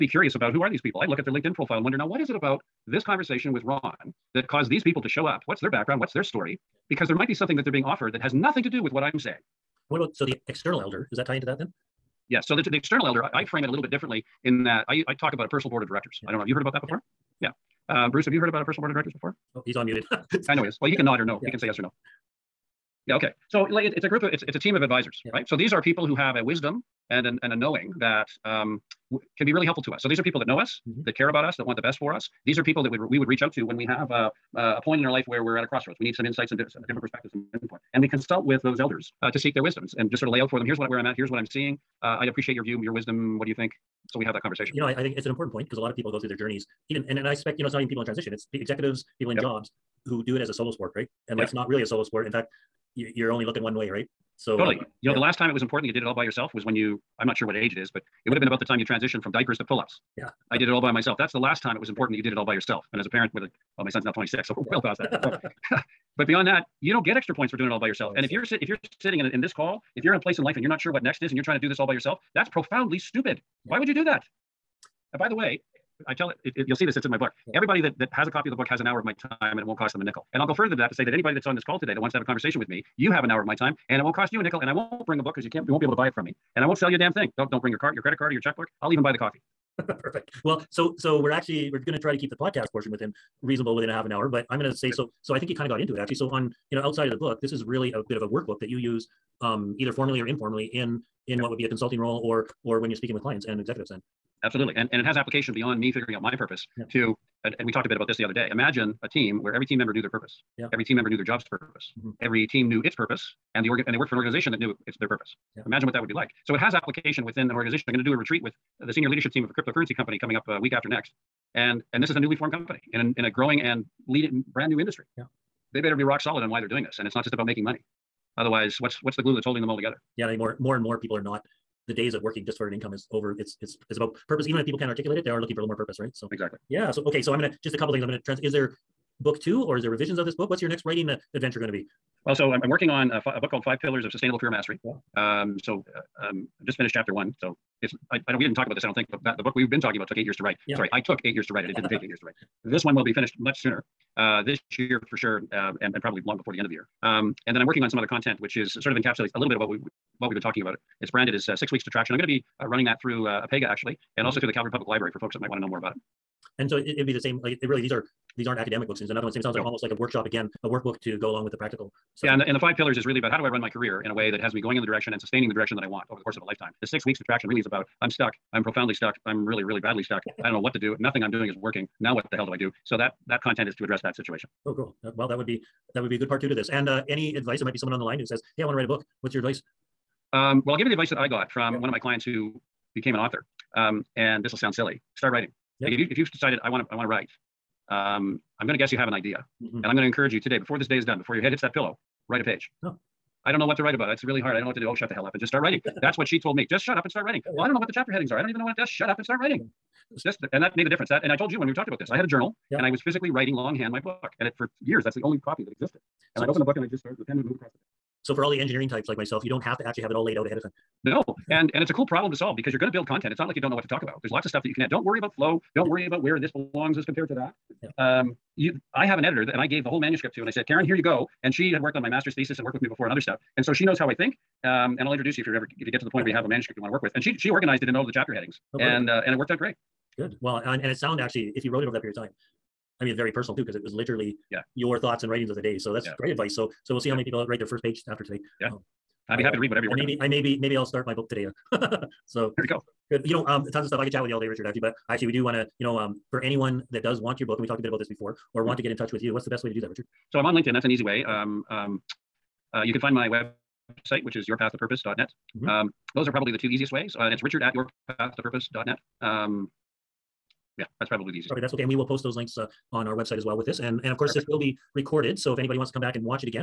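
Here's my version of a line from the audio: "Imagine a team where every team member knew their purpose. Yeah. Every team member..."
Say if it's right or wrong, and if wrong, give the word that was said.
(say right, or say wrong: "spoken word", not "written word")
right.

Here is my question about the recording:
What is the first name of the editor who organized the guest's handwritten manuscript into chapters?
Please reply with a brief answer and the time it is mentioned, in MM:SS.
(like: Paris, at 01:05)
Karen, at 03:50.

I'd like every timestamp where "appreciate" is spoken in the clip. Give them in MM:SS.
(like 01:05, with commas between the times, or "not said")
00:42.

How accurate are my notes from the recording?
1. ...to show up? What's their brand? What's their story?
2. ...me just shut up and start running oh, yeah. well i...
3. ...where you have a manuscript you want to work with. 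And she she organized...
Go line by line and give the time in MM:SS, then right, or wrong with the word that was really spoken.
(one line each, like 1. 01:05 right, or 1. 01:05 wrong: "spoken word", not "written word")
1. 00:05 wrong: "background", not "brand"
2. 03:26 wrong: "writing", not "running"
3. 03:56 right.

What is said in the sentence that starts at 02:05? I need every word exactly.
Yeah, they better be rock solid on why they're doing this, and it's not just about making money.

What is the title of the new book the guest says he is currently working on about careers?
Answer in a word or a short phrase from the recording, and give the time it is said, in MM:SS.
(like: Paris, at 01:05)
Five Pillars of Sustainable Career Mastery, at 02:23.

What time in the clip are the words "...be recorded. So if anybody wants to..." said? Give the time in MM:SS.
04:34.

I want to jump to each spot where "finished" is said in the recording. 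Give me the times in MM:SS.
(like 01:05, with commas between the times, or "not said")
02:26, 02:33.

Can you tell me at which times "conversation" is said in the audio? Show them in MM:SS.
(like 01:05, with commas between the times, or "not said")
00:03, 00:44, 01:22.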